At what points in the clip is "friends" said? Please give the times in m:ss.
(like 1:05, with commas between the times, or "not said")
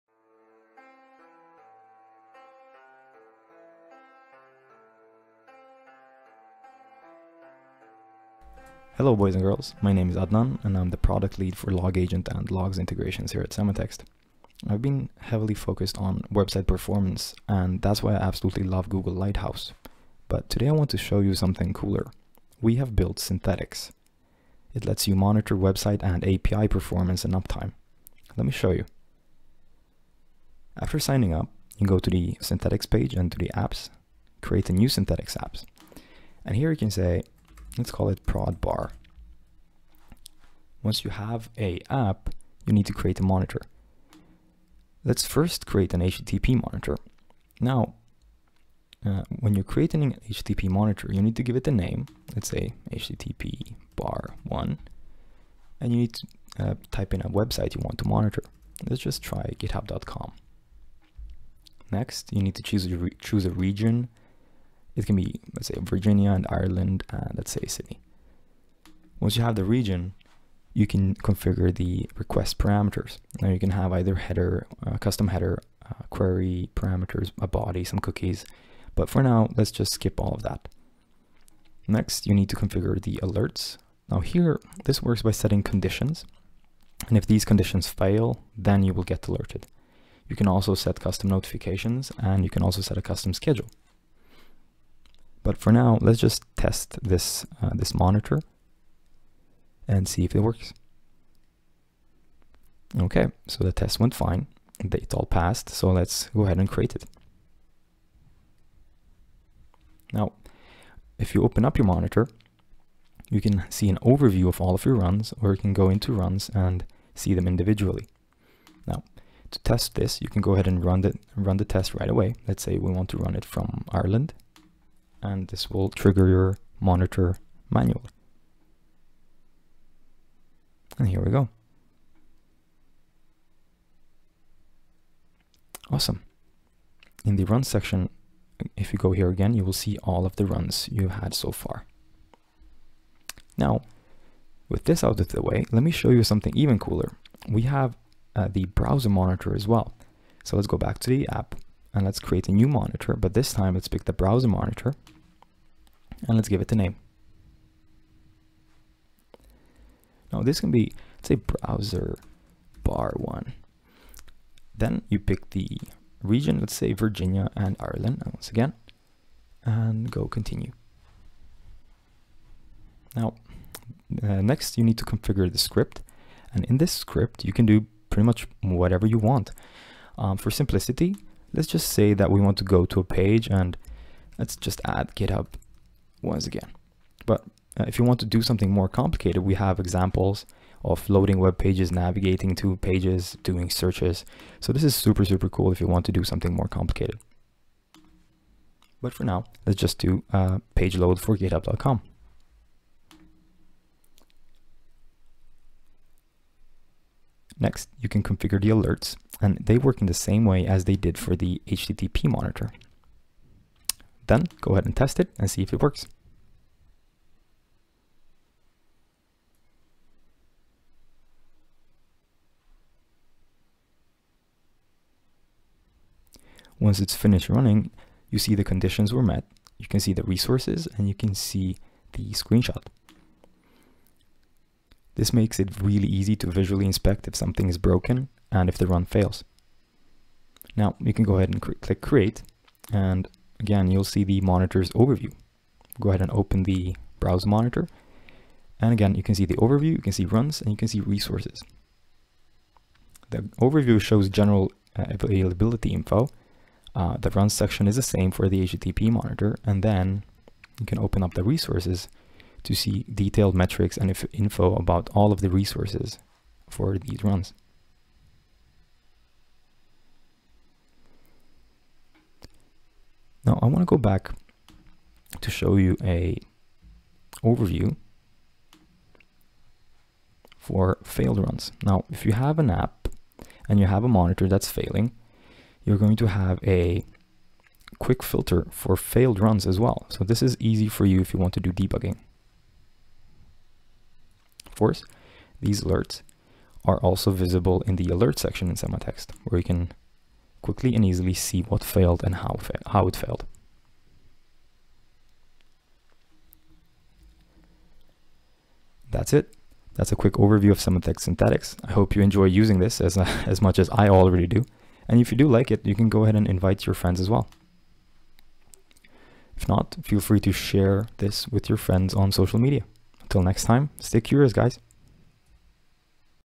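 5:16, 5:21.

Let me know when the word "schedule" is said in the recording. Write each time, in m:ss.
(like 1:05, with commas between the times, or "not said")
1:33.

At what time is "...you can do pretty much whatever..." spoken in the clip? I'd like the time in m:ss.
2:57.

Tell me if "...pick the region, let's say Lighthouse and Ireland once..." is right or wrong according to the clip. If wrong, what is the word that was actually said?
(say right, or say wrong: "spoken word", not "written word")
wrong: "Virginia", not "Lighthouse".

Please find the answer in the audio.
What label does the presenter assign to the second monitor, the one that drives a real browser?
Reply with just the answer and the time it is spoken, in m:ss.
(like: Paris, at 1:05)
browser bar one, at 2:41.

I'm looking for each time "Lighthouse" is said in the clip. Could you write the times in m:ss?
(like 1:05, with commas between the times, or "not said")
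0:19.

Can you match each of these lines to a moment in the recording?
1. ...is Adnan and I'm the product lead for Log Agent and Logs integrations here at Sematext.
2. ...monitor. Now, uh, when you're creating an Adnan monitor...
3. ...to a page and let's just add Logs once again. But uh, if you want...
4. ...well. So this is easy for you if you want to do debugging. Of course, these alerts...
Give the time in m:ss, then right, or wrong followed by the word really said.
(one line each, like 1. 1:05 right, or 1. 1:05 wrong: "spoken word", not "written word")
1. 0:10 right
2. 0:46 wrong: "HTTP", not "Adnan"
3. 3:02 wrong: "GitHub", not "Logs"
4. 4:49 right.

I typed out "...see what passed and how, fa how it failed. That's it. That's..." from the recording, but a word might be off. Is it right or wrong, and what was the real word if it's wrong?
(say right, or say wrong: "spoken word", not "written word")
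wrong: "failed", not "passed".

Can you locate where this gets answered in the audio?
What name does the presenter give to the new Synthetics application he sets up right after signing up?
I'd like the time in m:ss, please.
0:38.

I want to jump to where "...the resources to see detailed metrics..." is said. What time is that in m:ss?
4:21.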